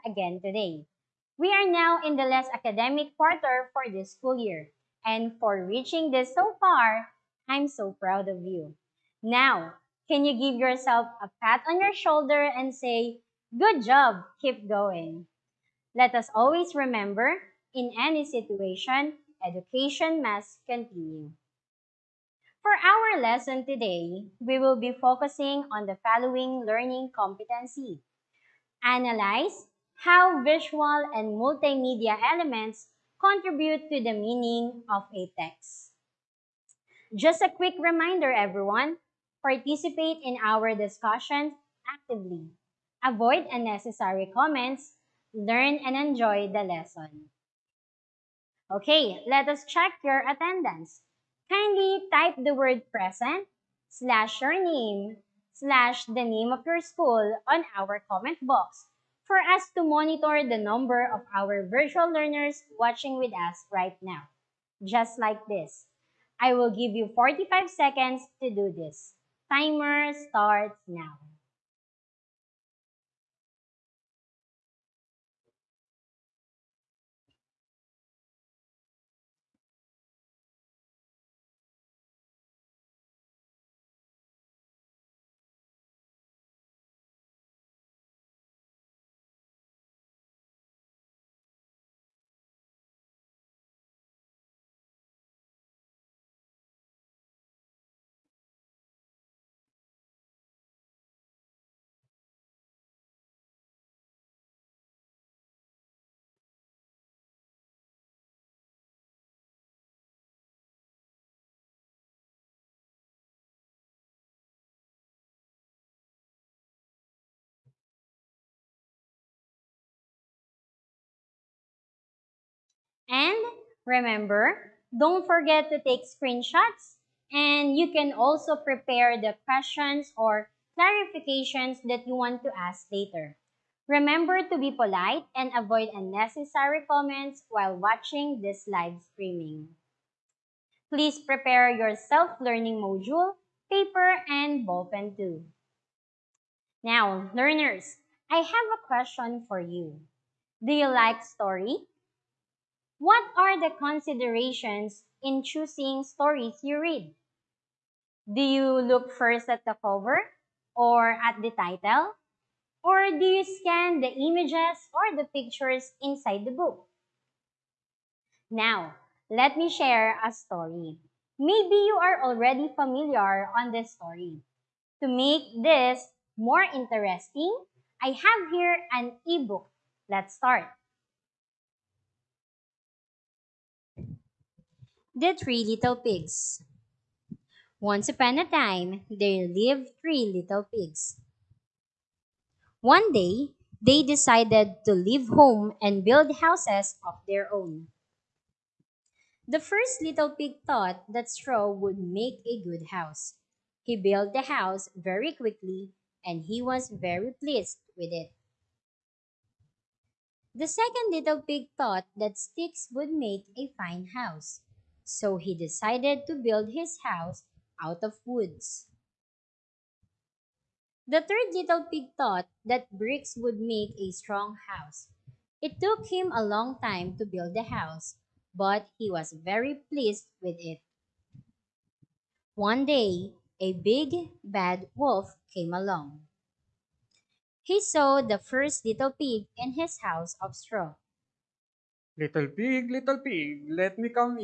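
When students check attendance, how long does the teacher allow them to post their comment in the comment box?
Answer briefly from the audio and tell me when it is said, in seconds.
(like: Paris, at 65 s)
45 seconds, at 67 s.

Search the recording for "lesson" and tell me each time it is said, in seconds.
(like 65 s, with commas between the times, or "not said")
23 s, 46 s.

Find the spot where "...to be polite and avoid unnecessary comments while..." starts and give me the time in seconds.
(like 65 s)
134 s.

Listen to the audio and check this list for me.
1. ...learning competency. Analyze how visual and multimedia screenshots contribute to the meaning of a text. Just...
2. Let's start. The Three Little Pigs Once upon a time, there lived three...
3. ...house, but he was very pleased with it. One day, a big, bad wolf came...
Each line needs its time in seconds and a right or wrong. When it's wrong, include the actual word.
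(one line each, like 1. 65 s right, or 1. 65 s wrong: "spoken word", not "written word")
1. 26 s wrong: "elements", not "screenshots"
2. 180 s right
3. 227 s right.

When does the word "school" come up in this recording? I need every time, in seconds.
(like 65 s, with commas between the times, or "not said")
4 s, 56 s.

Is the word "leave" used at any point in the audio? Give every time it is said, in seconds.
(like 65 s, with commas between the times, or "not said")
194 s.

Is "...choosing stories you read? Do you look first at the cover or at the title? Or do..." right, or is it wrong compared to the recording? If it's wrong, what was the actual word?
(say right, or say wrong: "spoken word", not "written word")
right.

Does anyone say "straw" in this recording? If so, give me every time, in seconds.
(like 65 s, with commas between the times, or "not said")
201 s, 240 s.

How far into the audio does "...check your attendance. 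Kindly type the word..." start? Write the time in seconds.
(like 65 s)
49 s.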